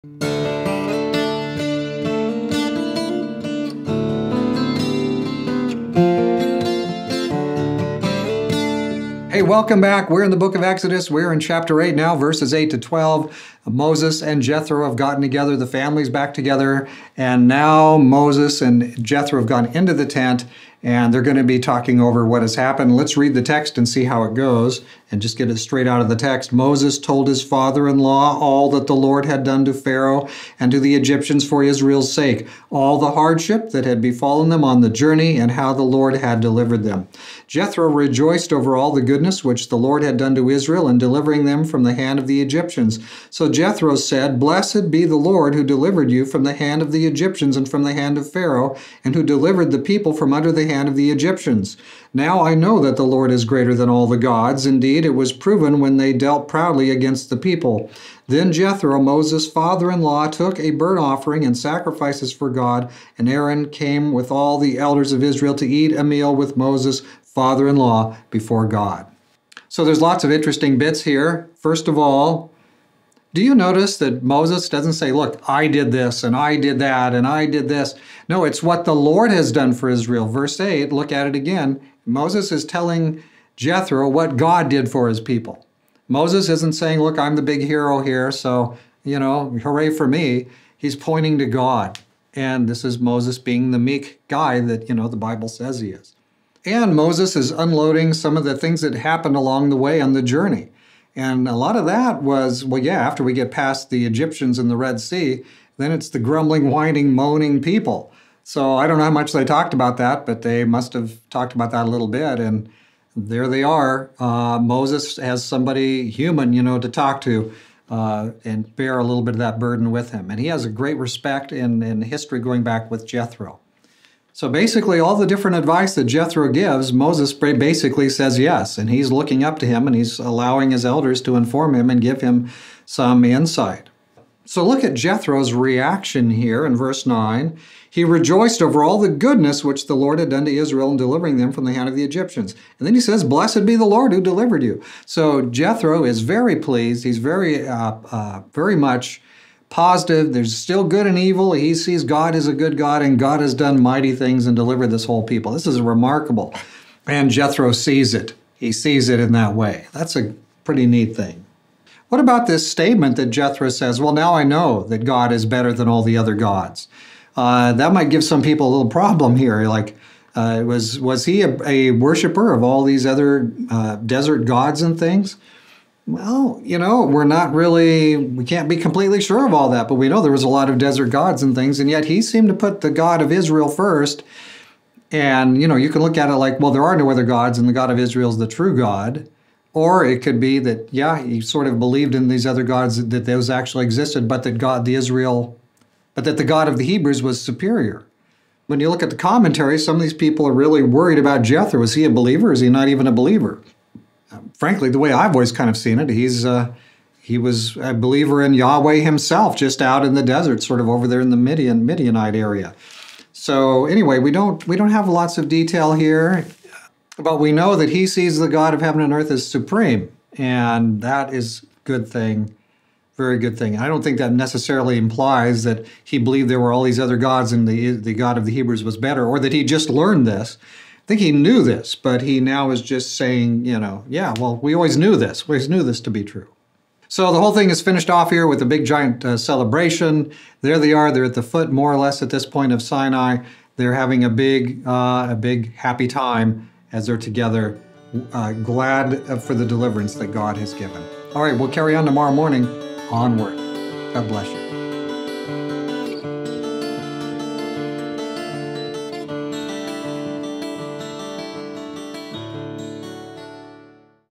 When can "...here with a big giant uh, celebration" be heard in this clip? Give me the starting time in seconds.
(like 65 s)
238 s.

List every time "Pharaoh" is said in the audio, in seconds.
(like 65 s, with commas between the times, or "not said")
29 s, 48 s.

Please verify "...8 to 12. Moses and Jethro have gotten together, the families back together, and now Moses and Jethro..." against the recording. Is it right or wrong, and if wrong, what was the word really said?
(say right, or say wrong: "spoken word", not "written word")
right.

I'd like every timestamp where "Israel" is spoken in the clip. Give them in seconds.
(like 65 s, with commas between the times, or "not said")
31 s, 40 s, 65 s, 79 s, 140 s, 183 s, 187 s, 194 s.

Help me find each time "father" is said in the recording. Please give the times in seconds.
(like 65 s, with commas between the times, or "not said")
27 s, 59 s, 67 s.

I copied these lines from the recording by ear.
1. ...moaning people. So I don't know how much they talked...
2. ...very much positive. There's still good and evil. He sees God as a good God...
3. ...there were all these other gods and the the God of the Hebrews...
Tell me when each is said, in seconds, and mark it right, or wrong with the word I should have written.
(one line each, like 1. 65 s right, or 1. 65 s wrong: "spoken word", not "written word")
1. 107 s right
2. 148 s right
3. 226 s right.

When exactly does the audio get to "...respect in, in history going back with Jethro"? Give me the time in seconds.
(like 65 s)
120 s.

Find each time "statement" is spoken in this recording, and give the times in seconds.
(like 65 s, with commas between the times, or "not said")
162 s.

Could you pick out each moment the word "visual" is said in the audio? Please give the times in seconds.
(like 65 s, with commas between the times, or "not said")
not said.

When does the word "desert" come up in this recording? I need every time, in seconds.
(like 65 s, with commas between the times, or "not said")
173 s, 180 s, 210 s.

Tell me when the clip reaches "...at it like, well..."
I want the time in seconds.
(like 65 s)
186 s.